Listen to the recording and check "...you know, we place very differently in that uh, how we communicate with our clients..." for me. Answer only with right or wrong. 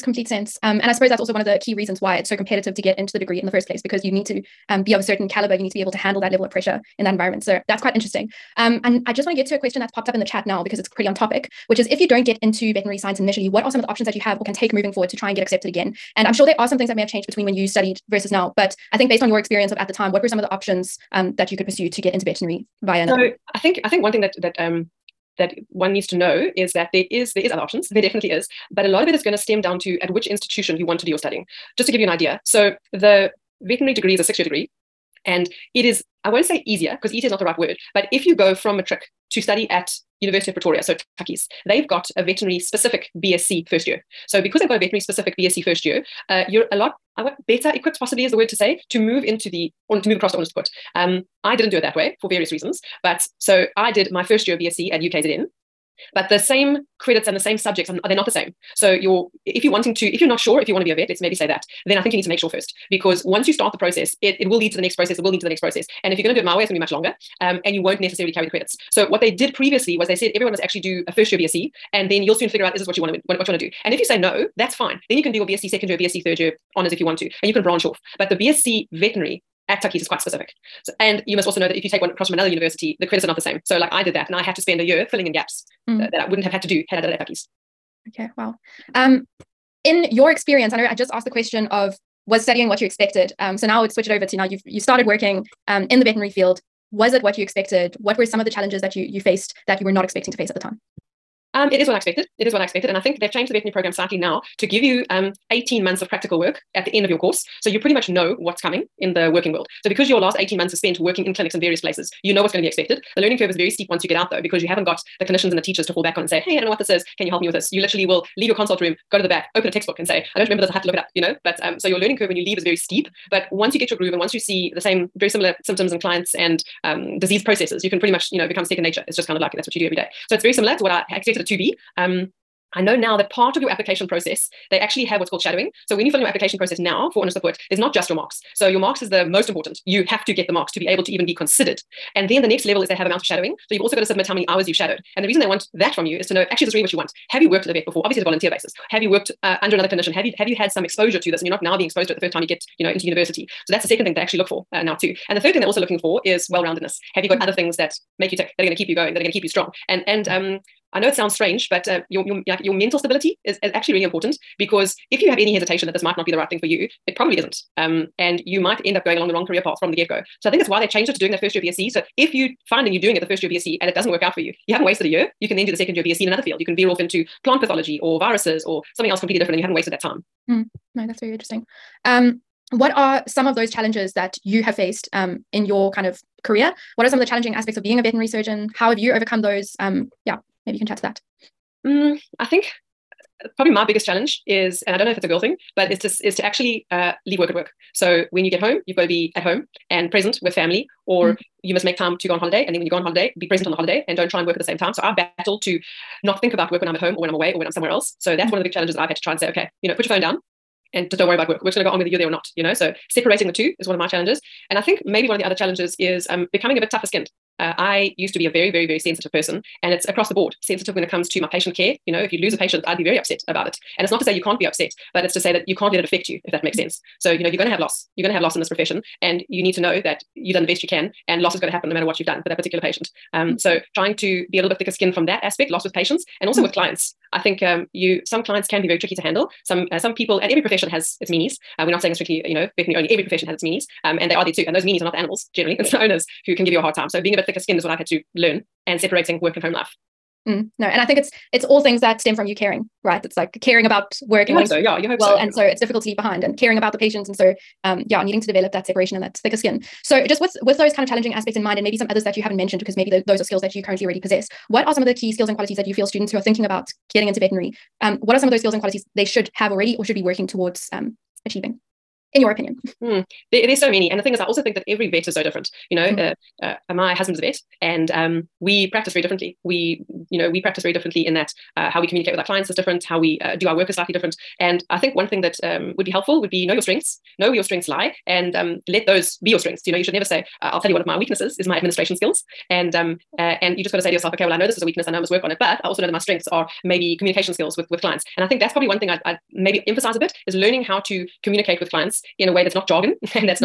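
wrong.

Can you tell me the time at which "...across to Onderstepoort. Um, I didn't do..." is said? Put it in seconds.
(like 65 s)
50 s.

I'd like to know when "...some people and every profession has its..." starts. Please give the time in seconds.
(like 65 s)
239 s.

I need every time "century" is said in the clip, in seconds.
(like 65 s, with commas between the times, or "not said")
not said.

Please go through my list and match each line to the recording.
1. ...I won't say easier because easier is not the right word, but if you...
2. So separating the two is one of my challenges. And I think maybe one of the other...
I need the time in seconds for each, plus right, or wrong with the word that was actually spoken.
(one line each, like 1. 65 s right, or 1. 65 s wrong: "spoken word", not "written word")
1. 36 s right
2. 212 s right.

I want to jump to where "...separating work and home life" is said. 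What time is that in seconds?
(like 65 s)
248 s.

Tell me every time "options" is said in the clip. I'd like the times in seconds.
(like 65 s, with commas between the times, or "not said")
13 s, 20 s, 27 s.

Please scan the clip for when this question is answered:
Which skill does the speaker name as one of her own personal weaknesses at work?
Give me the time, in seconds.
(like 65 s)
291 s.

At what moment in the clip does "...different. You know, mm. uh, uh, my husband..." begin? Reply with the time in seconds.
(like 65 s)
275 s.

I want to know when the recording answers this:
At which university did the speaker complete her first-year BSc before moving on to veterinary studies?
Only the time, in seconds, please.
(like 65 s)
54 s.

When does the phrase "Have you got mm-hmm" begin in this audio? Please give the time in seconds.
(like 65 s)
157 s.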